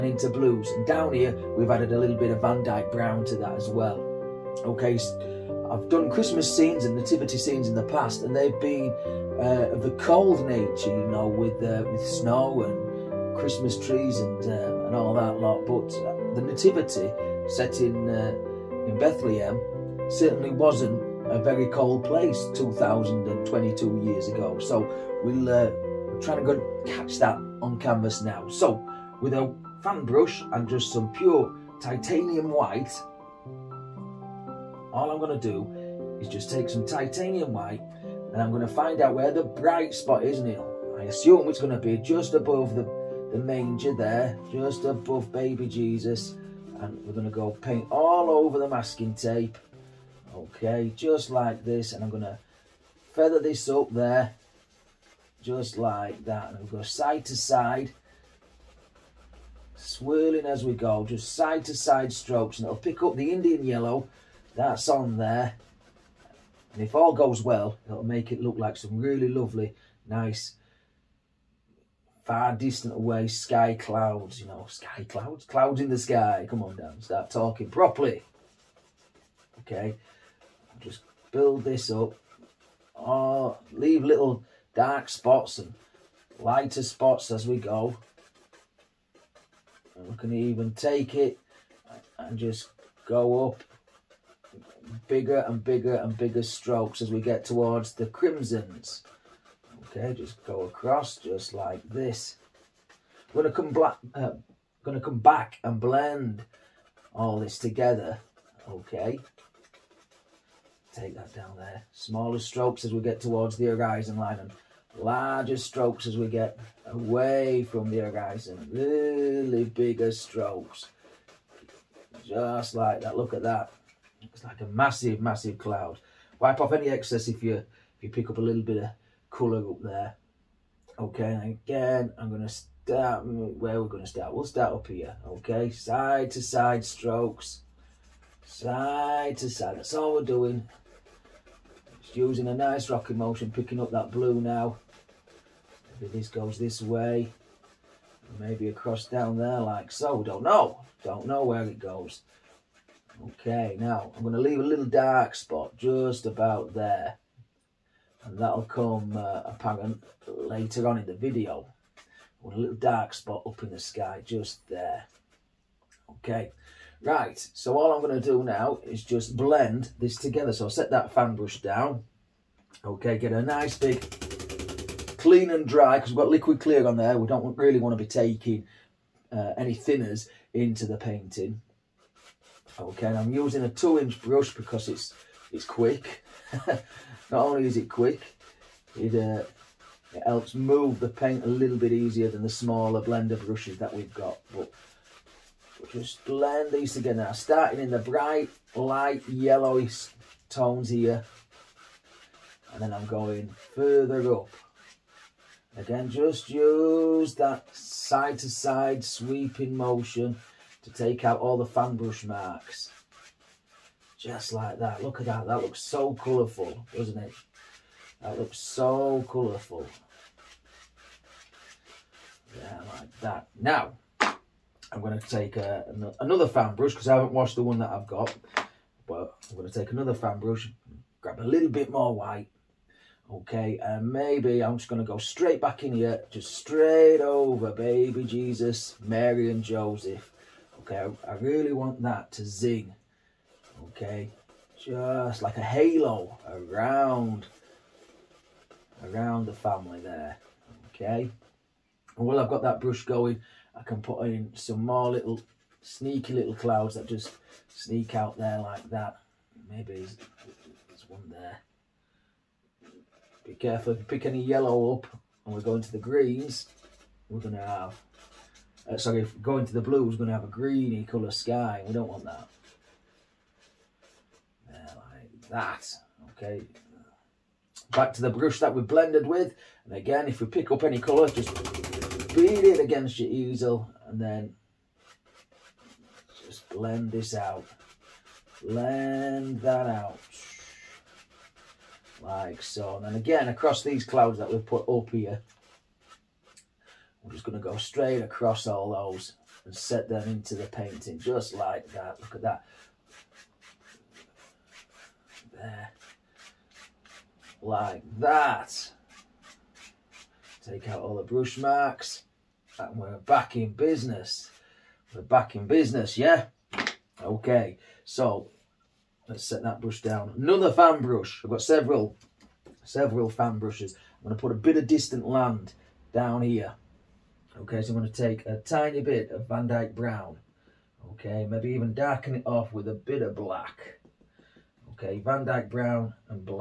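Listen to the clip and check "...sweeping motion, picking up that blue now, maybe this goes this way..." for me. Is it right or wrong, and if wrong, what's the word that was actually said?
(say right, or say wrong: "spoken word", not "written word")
wrong: "rocking", not "sweeping".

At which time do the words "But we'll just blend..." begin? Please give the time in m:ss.
3:14.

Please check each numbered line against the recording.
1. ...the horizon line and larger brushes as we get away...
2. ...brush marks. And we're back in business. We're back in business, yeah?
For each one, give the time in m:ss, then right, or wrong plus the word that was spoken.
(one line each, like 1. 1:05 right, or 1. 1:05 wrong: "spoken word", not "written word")
1. 1:53 wrong: "strokes", not "brushes"
2. 5:11 right.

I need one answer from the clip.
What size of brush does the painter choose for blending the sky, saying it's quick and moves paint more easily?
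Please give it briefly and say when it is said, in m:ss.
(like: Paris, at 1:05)
two inch, at 3:03.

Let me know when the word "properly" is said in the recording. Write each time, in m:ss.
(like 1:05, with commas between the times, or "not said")
1:17.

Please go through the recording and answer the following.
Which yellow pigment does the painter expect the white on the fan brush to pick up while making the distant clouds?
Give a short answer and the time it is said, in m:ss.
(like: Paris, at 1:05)
Indian yellow, at 1:03.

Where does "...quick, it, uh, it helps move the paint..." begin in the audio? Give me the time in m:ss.
3:07.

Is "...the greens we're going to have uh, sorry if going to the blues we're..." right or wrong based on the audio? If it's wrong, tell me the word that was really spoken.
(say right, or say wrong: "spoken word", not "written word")
right.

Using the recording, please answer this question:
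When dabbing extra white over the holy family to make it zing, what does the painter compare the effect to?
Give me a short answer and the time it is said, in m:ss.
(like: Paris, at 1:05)
a halo, at 4:05.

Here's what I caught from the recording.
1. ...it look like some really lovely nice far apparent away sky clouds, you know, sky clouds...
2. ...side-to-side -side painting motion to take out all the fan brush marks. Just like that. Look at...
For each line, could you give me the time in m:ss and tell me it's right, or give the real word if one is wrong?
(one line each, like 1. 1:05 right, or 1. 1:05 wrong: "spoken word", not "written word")
1. 1:08 wrong: "distant", not "apparent"
2. 3:27 wrong: "sweeping", not "painting".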